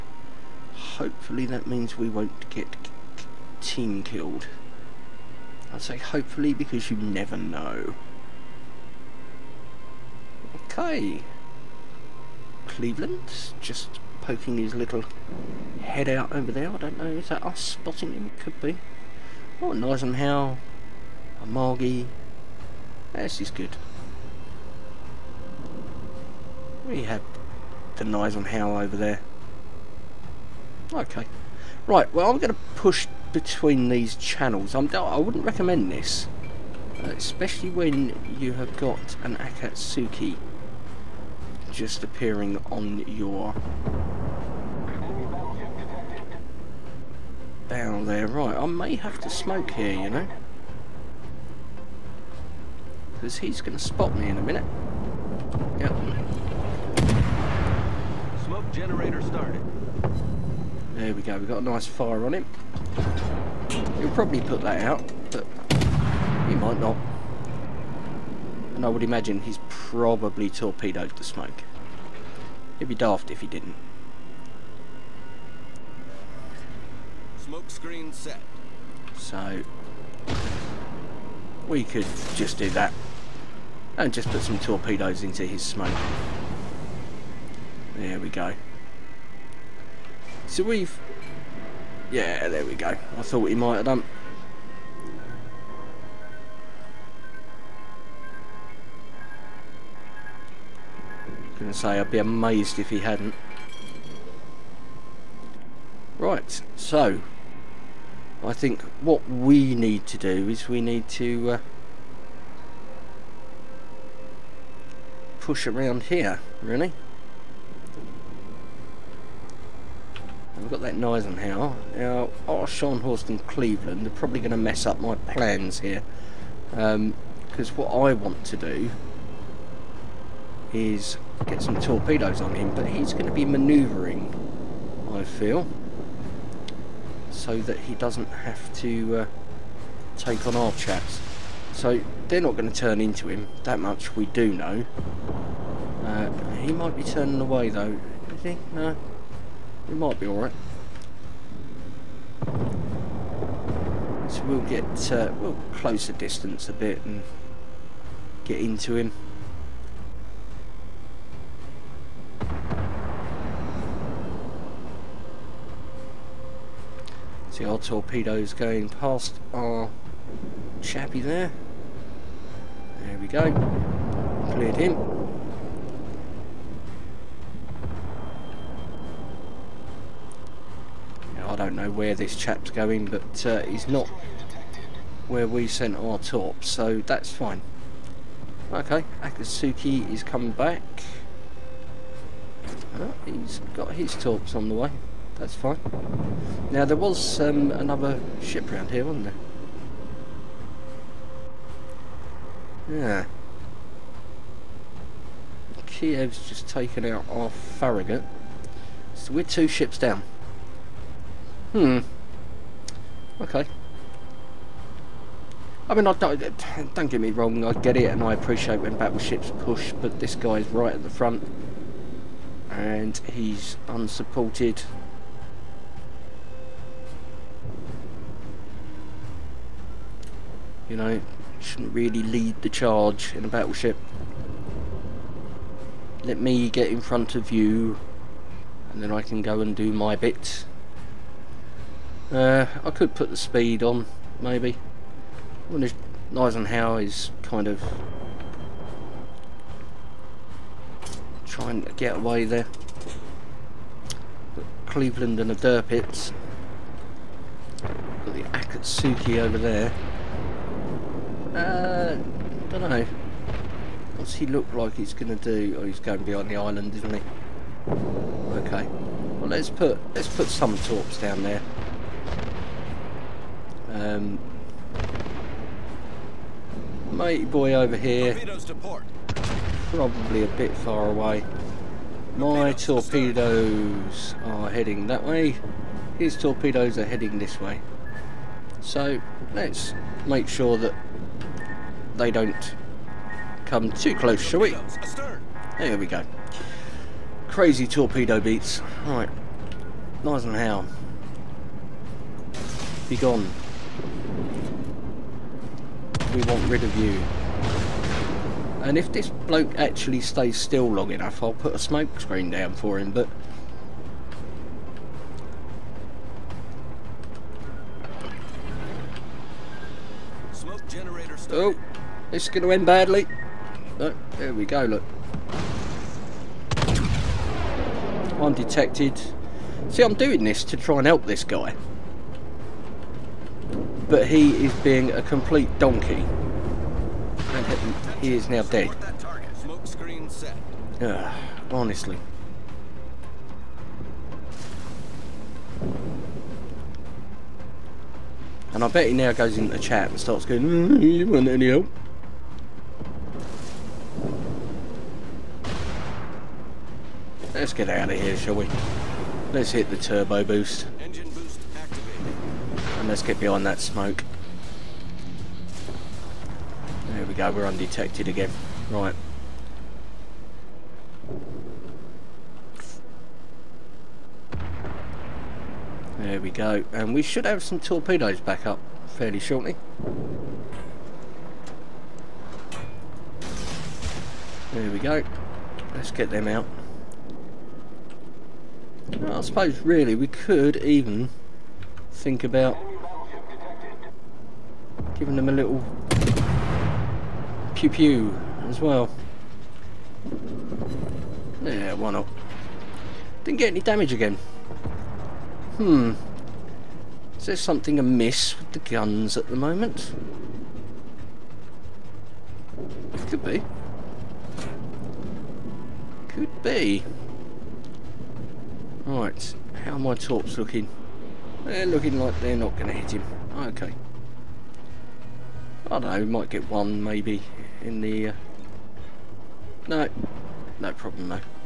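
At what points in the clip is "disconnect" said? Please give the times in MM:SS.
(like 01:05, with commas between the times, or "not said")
not said.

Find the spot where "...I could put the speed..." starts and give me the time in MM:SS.
04:02.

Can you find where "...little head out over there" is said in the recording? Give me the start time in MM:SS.
00:14.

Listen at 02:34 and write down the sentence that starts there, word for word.
So we'll get, uh, we'll close the distance a bit and get into him.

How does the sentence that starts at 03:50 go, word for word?
You know, shouldn't really lead the charge in a battleship.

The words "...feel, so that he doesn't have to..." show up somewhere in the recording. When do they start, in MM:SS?
02:15.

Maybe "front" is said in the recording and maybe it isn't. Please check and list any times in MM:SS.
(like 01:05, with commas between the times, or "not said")
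03:41, 03:57.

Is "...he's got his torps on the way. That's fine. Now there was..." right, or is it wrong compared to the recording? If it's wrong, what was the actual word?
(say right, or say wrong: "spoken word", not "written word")
right.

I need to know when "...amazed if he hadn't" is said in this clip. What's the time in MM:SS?
01:42.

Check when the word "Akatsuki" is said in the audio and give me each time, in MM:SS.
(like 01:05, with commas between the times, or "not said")
00:39, 03:09, 04:18.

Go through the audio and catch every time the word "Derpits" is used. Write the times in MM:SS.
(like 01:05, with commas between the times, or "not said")
04:15.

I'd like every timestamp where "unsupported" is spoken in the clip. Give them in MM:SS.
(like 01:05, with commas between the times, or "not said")
03:43.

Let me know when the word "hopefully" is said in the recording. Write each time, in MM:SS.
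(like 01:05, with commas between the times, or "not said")
00:00, 00:05.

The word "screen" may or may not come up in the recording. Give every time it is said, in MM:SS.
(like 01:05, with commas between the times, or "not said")
01:17, 05:12.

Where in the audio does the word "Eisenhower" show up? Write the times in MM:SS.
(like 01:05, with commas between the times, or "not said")
02:01, 04:06.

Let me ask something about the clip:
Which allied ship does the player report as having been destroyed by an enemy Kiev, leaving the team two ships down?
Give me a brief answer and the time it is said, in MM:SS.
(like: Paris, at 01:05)
Farragut, at 03:27.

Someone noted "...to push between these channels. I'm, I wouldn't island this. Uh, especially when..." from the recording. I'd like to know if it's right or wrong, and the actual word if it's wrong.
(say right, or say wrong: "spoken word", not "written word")
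wrong: "recommend", not "island".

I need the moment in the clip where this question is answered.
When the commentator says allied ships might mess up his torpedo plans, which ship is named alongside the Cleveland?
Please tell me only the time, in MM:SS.
02:02.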